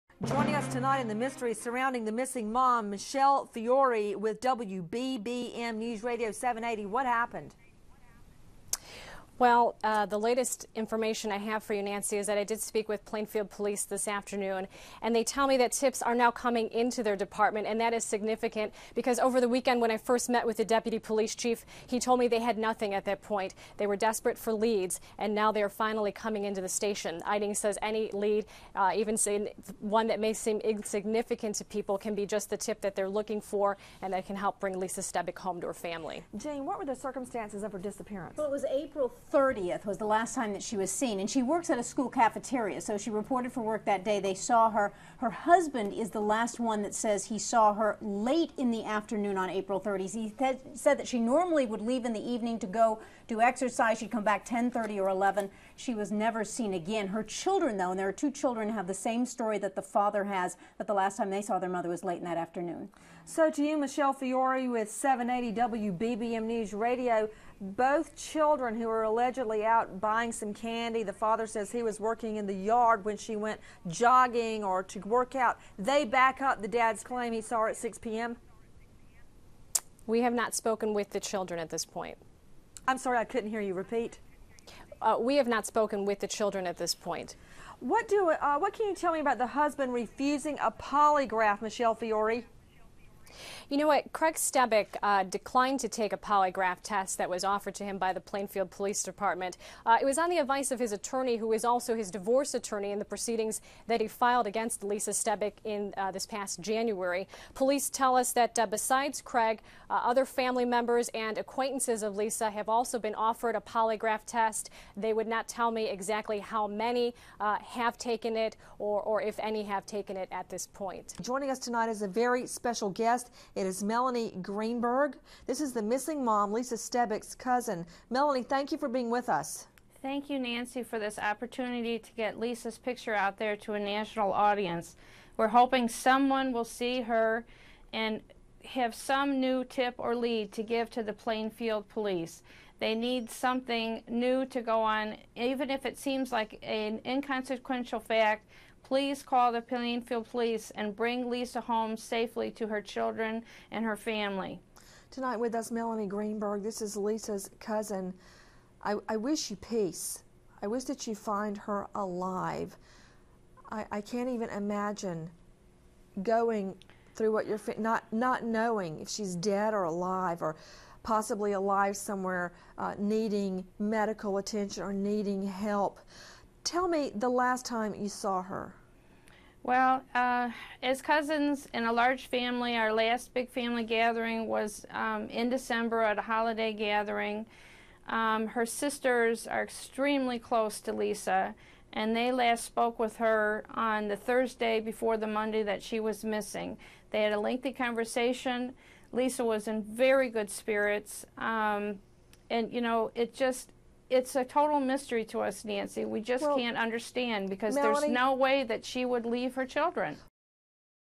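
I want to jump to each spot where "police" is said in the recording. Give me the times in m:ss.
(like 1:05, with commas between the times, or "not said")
0:13, 0:20, 1:38, 1:47, 2:21, 2:30.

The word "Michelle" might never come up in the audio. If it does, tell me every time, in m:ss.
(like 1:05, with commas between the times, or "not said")
0:02, 1:03, 1:31.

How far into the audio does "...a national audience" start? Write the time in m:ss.
2:13.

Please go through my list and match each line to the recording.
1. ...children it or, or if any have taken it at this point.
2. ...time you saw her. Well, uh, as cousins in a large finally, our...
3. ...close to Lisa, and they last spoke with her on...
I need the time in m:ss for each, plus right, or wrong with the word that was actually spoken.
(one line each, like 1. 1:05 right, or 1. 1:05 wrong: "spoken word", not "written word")
1. 1:57 wrong: "taken", not "children"
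2. 2:57 wrong: "family", not "finally"
3. 3:10 right.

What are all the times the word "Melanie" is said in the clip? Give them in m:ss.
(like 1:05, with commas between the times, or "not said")
2:03, 2:08, 2:35, 3:27.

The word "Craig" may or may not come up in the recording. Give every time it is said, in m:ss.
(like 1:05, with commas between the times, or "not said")
1:34, 1:49.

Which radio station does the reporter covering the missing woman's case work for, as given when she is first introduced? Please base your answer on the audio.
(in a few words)
WBBM News Radio 780.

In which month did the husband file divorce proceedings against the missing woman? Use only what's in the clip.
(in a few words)
January.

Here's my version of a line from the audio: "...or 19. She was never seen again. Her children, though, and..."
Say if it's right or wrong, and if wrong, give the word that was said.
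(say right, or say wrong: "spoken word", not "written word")
wrong: "11", not "19".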